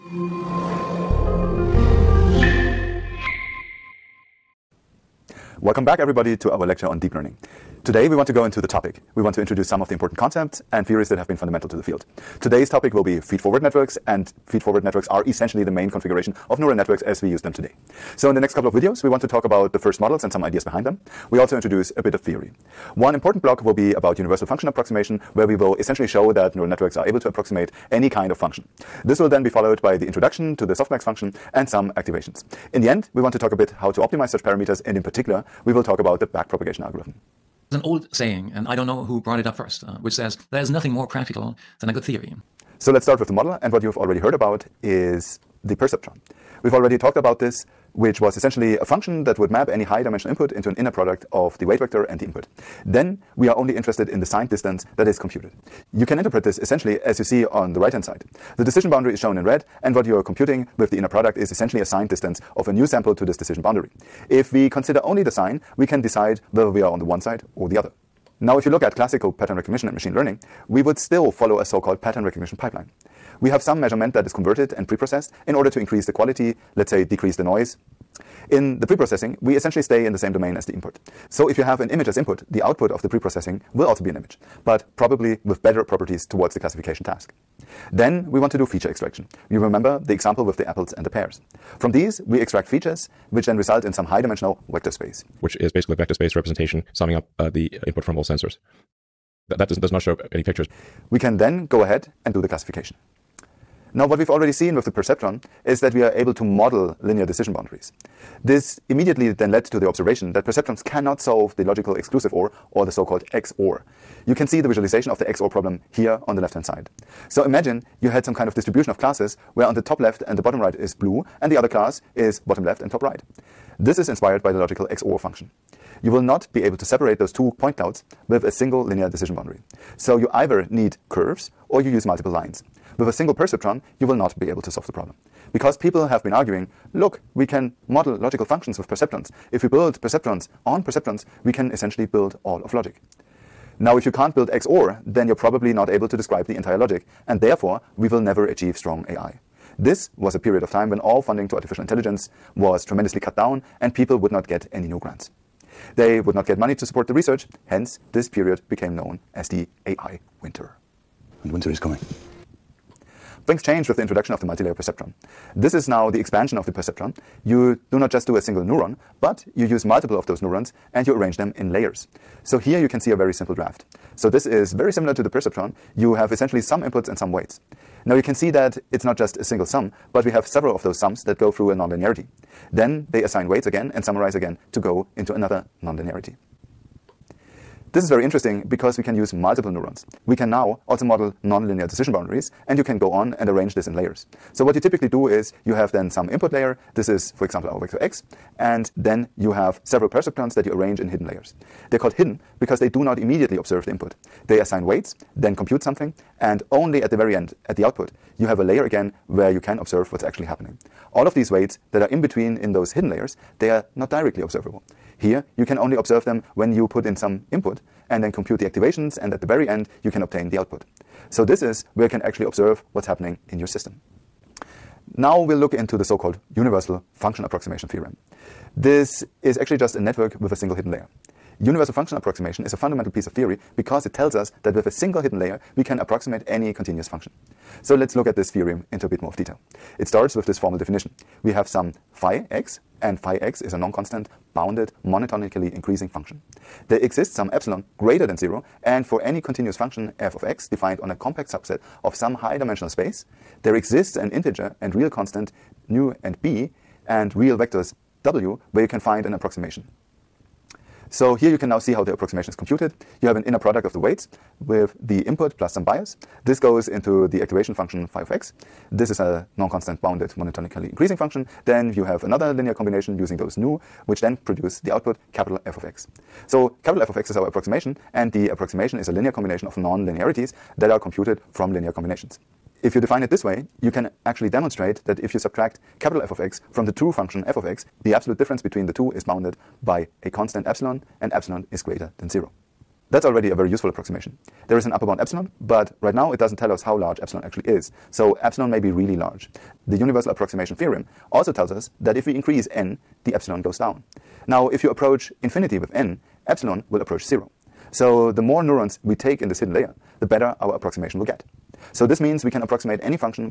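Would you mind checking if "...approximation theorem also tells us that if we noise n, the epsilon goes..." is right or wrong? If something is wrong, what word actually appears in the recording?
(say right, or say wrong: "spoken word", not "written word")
wrong: "increase", not "noise".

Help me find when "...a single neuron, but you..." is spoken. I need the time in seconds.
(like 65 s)
168 s.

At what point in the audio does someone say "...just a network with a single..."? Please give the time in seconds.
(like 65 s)
229 s.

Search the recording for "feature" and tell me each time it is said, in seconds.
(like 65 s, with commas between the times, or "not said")
88 s, 92 s.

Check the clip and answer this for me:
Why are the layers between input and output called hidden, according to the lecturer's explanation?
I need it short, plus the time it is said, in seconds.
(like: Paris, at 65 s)
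They do not immediately observe the input, at 202 s.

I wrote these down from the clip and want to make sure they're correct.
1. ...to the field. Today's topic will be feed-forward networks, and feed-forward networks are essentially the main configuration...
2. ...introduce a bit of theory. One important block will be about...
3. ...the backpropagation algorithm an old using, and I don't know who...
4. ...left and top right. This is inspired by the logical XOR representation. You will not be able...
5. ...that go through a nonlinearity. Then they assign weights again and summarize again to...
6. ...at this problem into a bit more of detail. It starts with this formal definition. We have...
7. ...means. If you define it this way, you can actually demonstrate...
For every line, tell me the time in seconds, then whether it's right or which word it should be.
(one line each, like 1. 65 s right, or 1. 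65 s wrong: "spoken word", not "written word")
1. 11 s right
2. 21 s right
3. 36 s wrong: "saying", not "using"
4. 122 s wrong: "function", not "representation"
5. 181 s right
6. 238 s wrong: "theorem", not "problem"
7. 281 s wrong: "combinations", not "means".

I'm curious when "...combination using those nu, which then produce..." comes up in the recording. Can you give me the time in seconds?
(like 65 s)
272 s.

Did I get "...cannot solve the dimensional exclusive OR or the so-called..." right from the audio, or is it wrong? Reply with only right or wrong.
wrong.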